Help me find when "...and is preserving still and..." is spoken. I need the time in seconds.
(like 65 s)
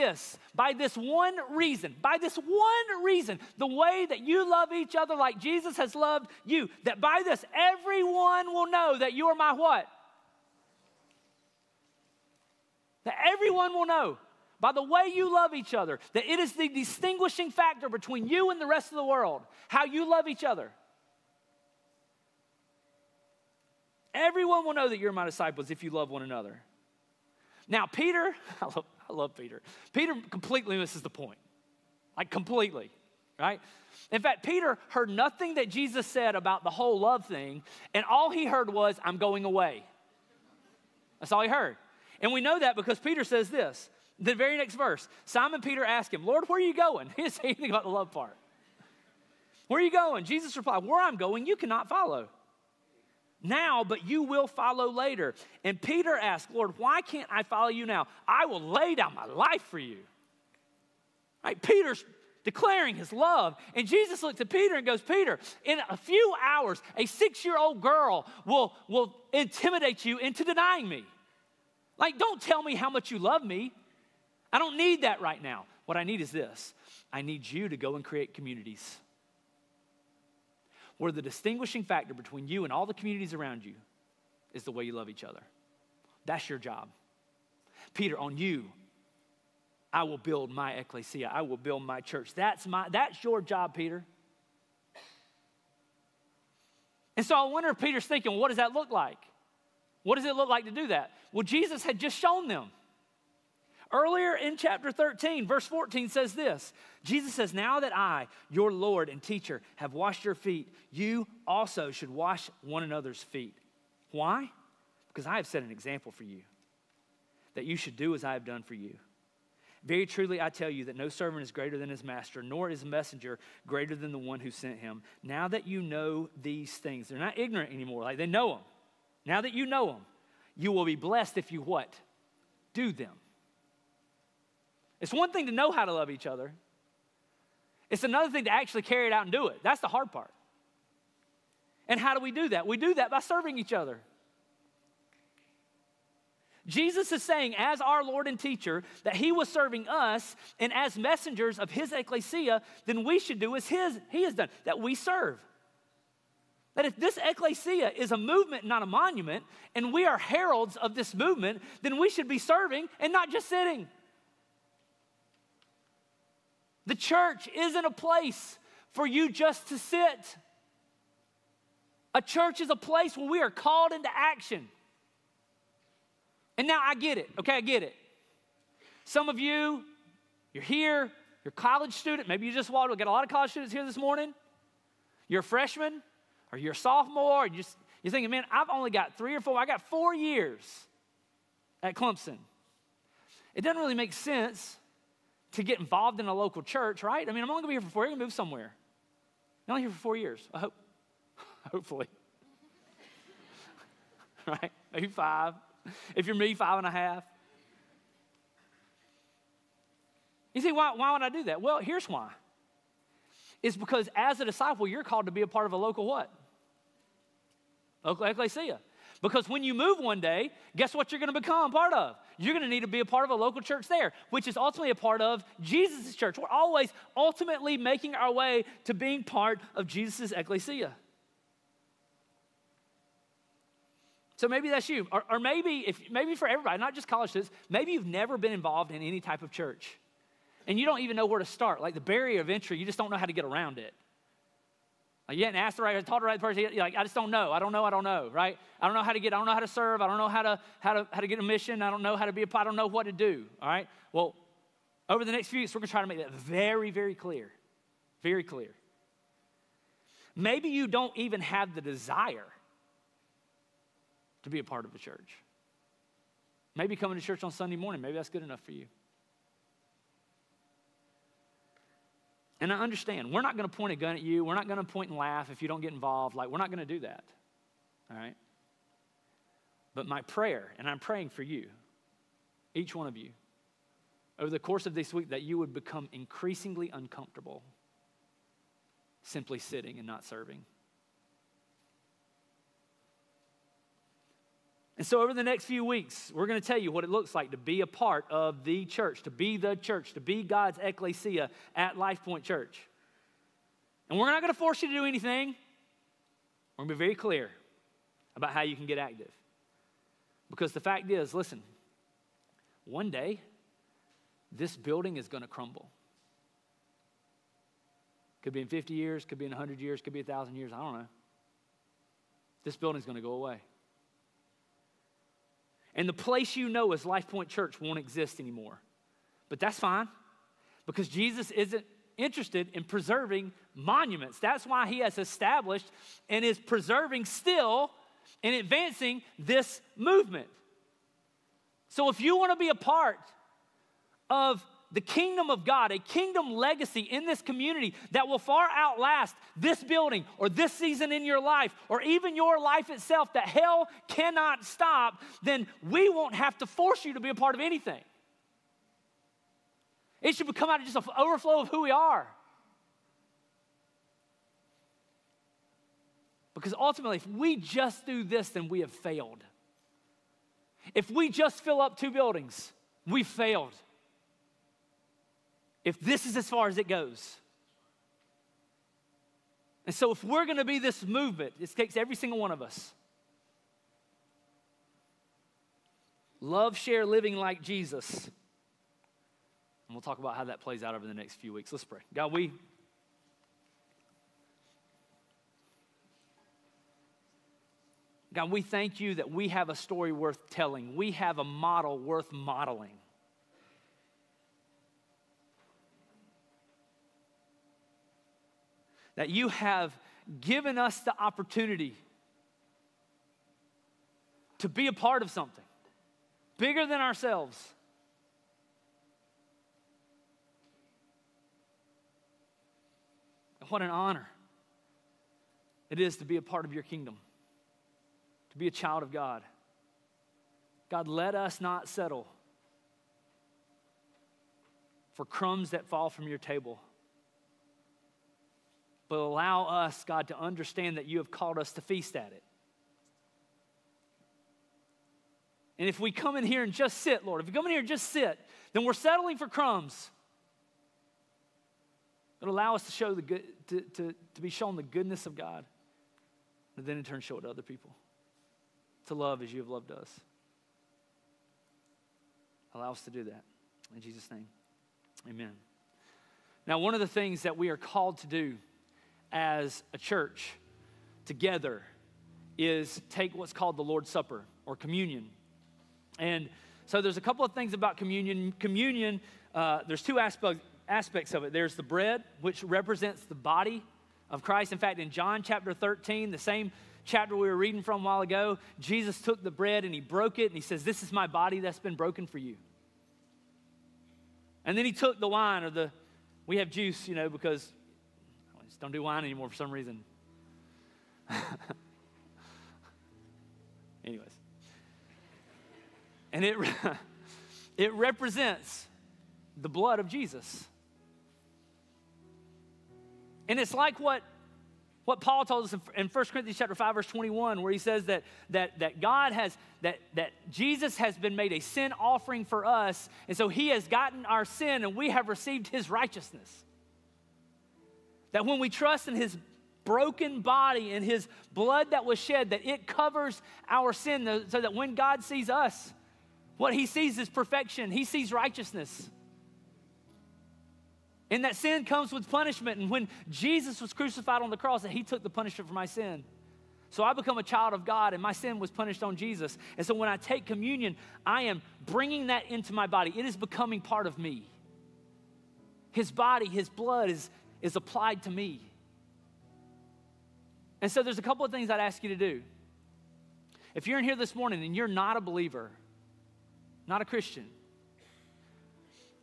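336 s.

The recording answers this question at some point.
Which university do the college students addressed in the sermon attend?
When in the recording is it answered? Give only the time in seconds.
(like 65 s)
191 s.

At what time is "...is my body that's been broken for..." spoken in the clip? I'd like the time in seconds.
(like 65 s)
491 s.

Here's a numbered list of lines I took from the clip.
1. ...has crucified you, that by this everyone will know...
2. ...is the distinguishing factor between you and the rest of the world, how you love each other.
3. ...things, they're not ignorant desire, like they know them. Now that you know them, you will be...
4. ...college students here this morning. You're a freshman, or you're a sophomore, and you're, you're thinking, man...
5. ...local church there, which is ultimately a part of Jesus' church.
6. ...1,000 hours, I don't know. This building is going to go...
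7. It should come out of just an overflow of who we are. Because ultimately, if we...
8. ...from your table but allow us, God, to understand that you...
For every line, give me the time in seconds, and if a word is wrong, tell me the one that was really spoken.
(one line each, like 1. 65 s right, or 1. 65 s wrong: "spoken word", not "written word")
1. 5 s wrong: "loved", not "crucified"
2. 16 s right
3. 126 s wrong: "anymore", not "desire"
4. 183 s right
5. 223 s right
6. 320 s wrong: "years", not "hours"
7. 360 s right
8. 436 s right.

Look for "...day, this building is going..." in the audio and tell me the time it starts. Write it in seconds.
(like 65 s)
313 s.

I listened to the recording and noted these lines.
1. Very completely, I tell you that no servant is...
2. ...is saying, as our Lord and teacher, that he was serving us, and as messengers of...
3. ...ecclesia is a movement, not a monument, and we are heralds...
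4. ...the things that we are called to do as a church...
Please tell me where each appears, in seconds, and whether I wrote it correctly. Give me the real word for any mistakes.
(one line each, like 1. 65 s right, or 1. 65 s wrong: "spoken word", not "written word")
1. 119 s wrong: "truly", not "completely"
2. 147 s right
3. 157 s right
4. 467 s right.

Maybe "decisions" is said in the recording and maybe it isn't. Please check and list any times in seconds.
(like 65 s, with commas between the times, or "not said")
not said.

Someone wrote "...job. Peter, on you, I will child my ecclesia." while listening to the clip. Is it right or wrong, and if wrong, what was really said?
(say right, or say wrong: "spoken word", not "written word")
wrong: "build", not "child".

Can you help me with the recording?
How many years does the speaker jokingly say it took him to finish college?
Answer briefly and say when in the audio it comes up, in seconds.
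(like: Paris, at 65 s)
5 and a half, at 206 s.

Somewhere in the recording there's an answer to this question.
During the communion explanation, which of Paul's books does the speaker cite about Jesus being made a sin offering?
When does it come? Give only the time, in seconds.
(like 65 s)
516 s.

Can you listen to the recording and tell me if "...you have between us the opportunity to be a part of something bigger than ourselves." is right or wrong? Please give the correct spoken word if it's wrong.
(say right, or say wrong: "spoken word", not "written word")
wrong: "given", not "between".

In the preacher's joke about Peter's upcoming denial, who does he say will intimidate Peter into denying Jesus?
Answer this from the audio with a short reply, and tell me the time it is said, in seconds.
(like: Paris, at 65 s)
a six year old girl, at 66 s.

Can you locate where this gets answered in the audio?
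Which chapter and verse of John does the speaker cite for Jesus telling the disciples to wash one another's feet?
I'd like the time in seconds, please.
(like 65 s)
104 s.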